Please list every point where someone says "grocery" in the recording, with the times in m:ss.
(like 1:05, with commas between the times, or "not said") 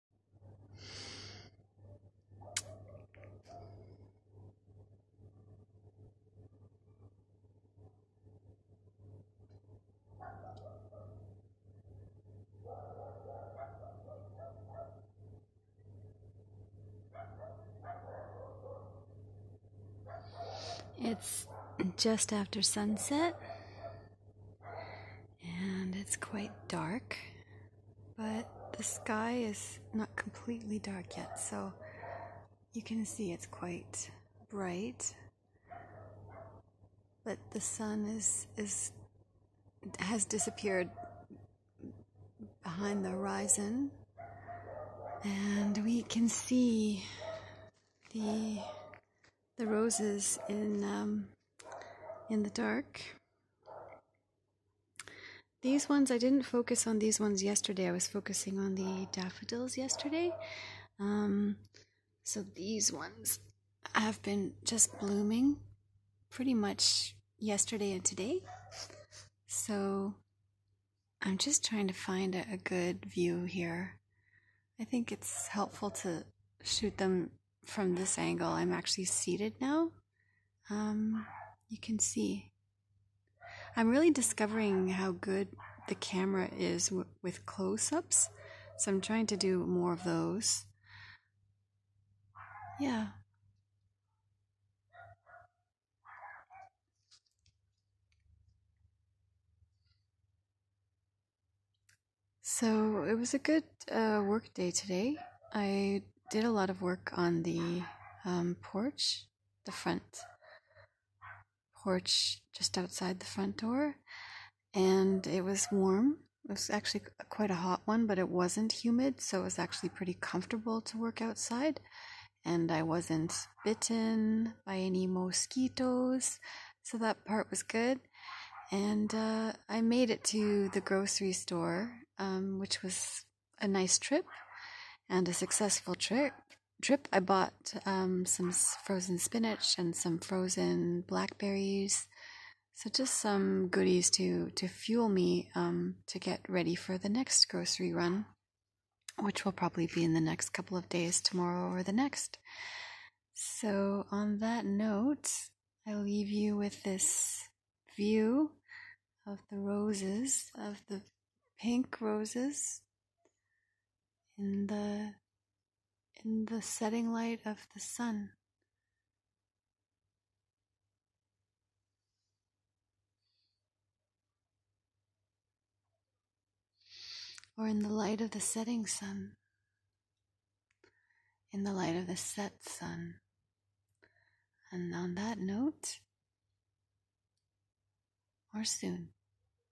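2:10, 2:27.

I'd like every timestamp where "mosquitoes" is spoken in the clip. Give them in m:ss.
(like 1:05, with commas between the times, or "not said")
2:05.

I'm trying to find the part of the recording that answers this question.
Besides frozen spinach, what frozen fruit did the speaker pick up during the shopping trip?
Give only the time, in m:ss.
2:20.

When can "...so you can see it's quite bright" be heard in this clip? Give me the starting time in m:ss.
0:31.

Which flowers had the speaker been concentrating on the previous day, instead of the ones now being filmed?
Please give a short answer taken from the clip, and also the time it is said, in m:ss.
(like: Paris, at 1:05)
daffodils, at 0:59.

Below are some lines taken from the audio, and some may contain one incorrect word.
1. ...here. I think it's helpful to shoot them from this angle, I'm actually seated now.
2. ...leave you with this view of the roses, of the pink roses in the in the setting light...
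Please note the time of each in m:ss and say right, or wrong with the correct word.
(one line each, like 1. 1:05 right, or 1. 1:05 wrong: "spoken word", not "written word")
1. 1:13 right
2. 2:35 right.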